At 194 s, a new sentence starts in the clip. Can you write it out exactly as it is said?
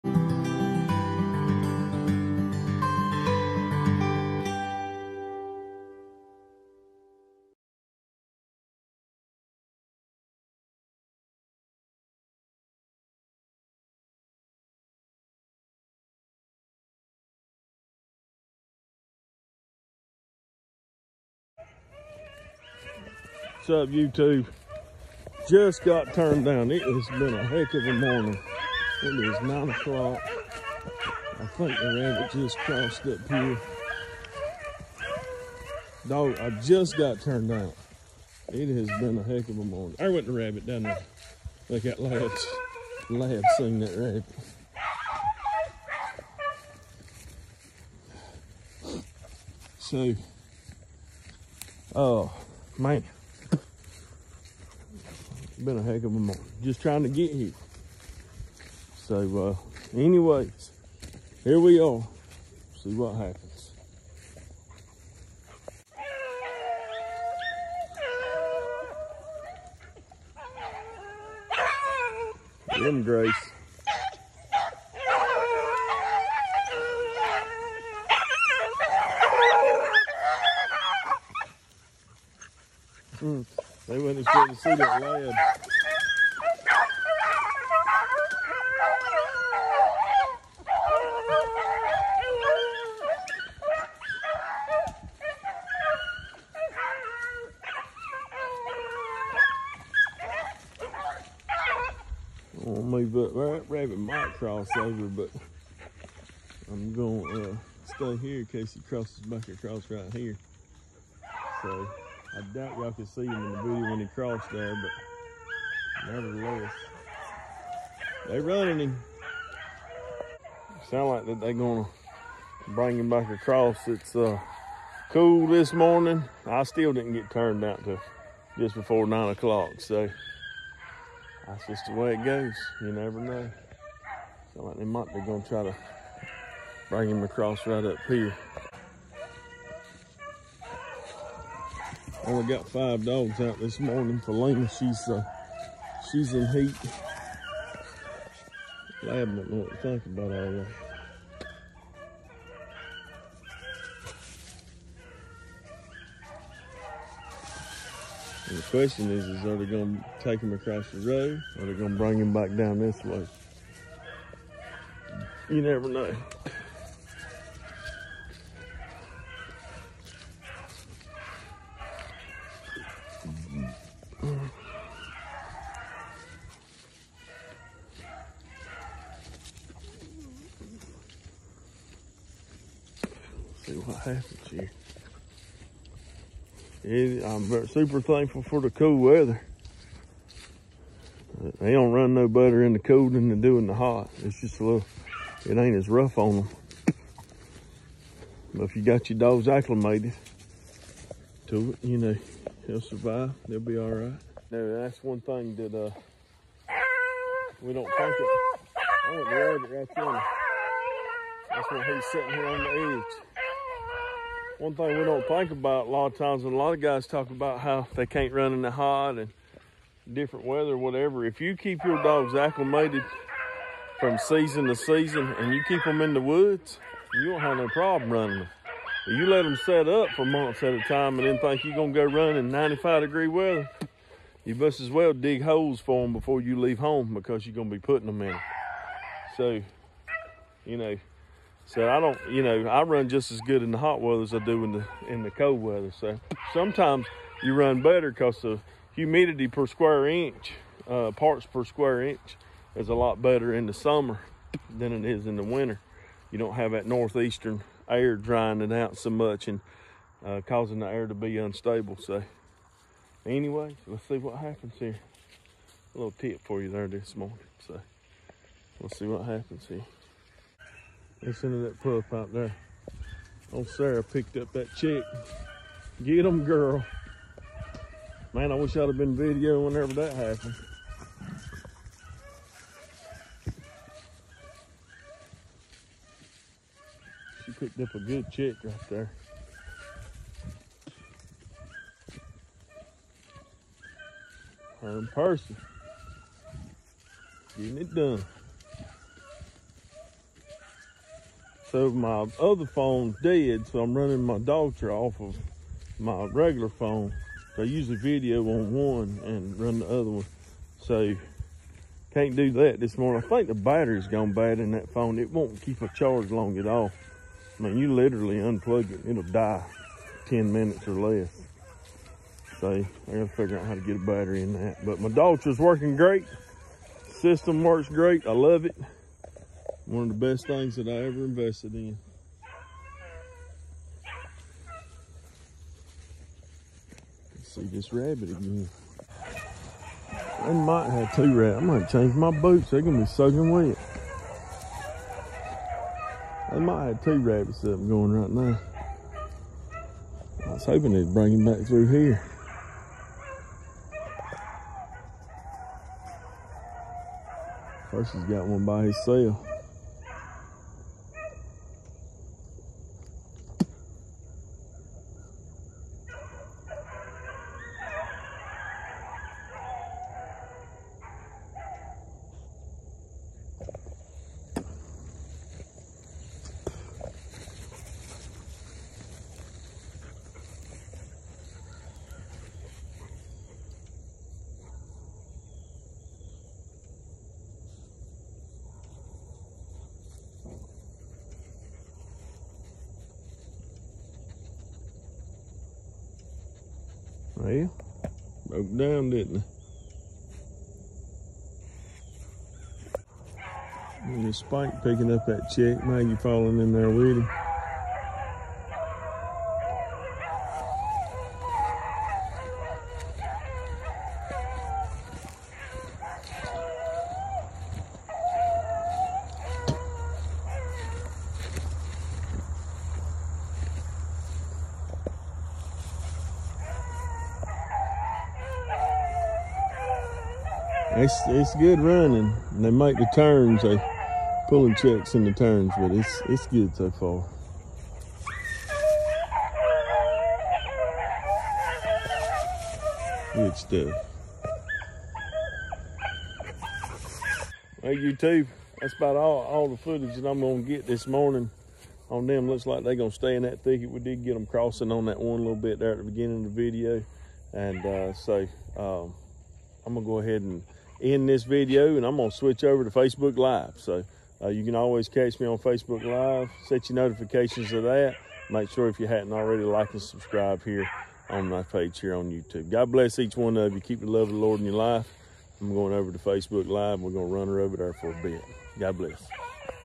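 It's just a little, it ain't as rough on them.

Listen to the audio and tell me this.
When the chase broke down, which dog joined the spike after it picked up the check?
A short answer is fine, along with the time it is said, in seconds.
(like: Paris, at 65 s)
Maggie, at 405 s.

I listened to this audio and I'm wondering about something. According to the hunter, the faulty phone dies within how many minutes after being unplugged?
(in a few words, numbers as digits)
10 minutes.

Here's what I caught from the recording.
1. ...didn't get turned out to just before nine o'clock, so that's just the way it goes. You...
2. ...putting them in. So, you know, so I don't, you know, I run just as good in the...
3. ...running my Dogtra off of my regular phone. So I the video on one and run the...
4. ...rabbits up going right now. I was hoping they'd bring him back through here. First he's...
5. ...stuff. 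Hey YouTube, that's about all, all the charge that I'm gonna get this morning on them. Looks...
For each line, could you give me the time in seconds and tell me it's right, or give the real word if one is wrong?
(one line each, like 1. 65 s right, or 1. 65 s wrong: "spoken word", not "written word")
1. 126 s right
2. 237 s right
3. 303 s right
4. 347 s right
5. 443 s wrong: "footage", not "charge".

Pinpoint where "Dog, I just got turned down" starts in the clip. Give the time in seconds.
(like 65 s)
36 s.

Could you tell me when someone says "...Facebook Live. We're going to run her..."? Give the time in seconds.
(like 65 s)
476 s.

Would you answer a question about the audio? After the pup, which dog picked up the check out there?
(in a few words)
Sarah.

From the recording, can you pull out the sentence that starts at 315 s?
It won't keep a charge long at all.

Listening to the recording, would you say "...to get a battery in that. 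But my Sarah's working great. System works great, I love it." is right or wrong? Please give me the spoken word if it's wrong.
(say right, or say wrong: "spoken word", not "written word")
wrong: "Dogtra", not "Sarah".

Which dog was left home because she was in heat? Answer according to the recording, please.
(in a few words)
Lena.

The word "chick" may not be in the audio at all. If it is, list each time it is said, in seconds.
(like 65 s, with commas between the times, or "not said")
274 s, 288 s, 405 s.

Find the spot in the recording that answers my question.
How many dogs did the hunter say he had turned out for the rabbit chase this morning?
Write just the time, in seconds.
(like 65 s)
142 s.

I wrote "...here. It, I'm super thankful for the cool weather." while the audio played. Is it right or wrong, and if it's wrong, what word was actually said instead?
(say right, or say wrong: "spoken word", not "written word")
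right.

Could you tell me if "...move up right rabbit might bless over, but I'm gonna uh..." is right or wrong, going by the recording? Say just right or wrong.
wrong.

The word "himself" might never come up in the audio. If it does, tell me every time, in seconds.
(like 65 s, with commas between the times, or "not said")
358 s.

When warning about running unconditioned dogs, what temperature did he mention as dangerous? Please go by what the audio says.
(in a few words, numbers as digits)
95 degrees.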